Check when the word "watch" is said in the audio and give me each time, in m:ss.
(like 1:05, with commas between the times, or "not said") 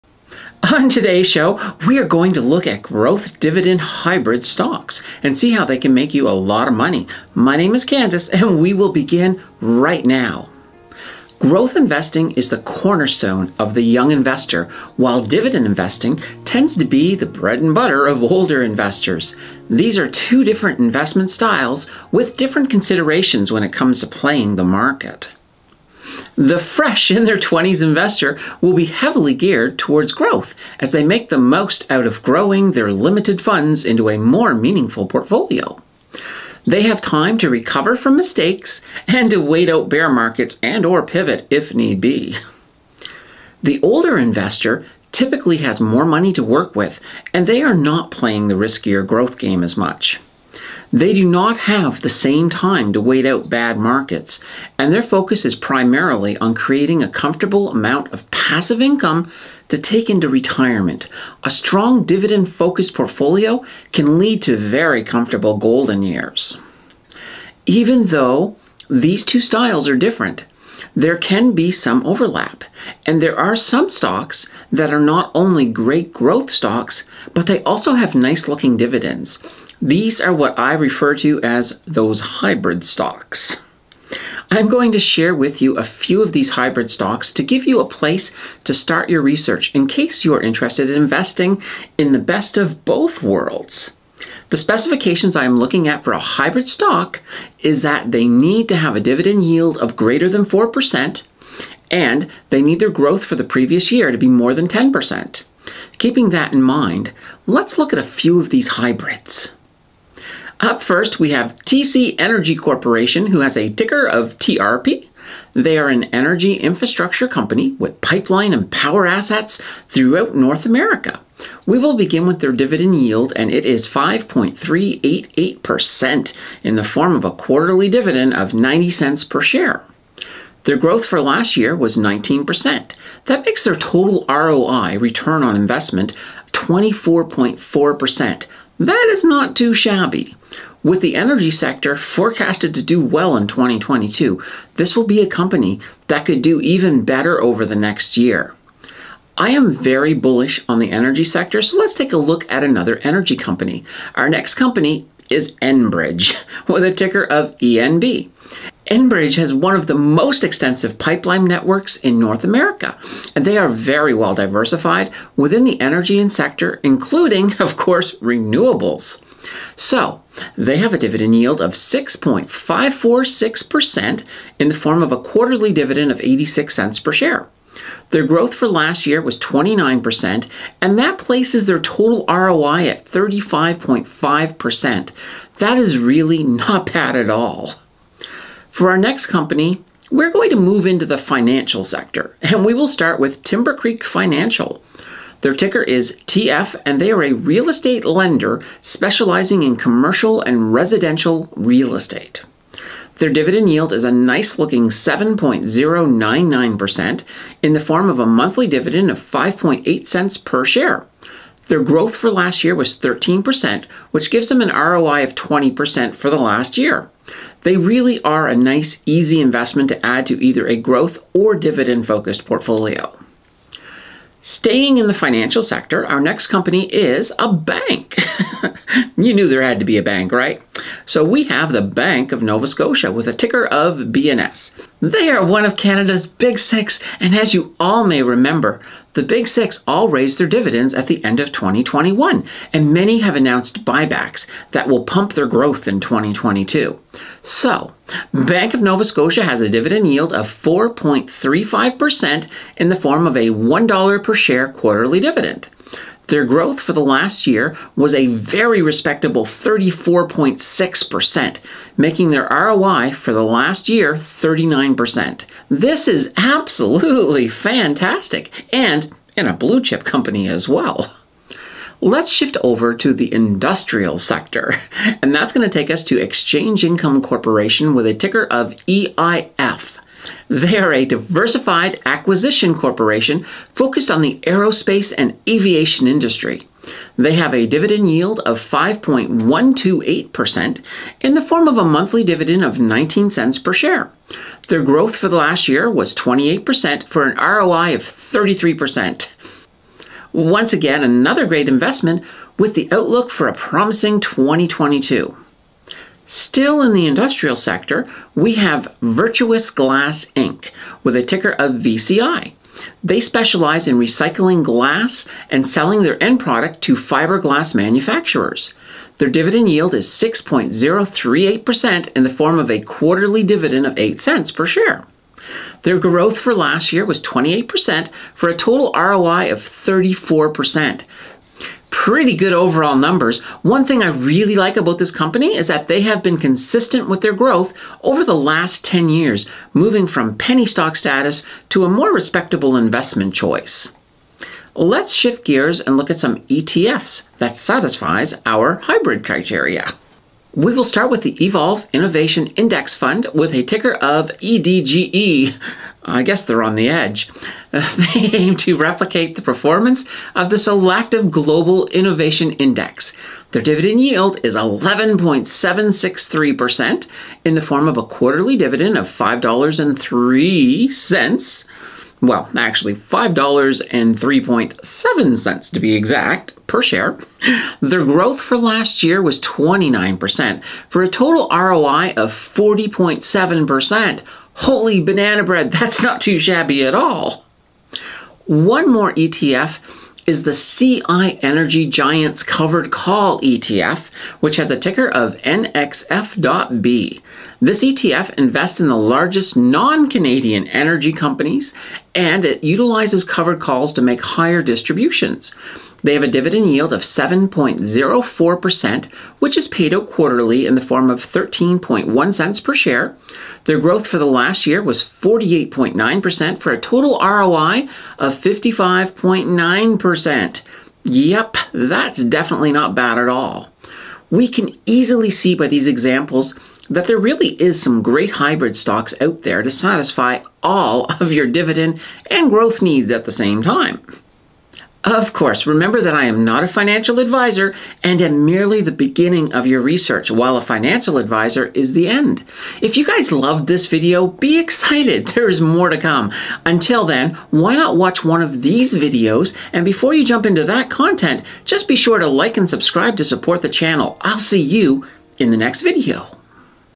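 7:27.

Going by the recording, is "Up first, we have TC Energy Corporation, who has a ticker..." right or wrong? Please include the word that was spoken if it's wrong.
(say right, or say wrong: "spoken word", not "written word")
right.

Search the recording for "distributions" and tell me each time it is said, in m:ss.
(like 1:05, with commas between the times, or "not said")
6:44.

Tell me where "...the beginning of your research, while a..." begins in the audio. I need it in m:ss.
7:18.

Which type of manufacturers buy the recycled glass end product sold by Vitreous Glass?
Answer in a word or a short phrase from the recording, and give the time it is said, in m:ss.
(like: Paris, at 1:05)
fiberglass manufacturers, at 5:16.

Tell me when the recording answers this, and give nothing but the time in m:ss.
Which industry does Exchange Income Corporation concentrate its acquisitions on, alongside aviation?
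4:44.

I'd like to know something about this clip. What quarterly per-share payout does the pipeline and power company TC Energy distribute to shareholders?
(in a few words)
90 cents.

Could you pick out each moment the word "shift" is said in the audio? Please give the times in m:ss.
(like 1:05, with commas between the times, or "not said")
4:32, 5:45.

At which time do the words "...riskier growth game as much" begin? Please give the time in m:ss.
0:48.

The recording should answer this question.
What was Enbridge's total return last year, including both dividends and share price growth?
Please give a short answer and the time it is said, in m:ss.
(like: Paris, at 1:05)
35.5%, at 3:03.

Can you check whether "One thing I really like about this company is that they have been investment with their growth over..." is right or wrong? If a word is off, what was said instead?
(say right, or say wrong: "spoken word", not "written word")
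wrong: "consistent", not "investment".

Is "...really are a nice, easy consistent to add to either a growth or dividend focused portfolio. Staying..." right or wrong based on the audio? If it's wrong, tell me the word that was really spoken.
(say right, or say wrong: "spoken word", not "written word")
wrong: "investment", not "consistent".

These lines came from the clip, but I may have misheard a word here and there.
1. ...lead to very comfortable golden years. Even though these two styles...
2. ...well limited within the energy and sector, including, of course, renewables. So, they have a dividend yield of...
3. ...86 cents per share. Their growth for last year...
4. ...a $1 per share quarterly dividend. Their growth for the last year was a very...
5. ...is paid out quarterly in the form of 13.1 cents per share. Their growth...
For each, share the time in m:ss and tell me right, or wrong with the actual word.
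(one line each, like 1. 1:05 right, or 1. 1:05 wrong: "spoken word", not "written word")
1. 1:04 right
2. 2:44 wrong: "diversified", not "limited"
3. 2:56 right
4. 4:13 right
5. 6:49 right.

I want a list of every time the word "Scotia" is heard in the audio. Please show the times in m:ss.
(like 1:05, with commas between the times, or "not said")
3:52, 4:09.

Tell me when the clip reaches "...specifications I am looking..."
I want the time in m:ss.
1:34.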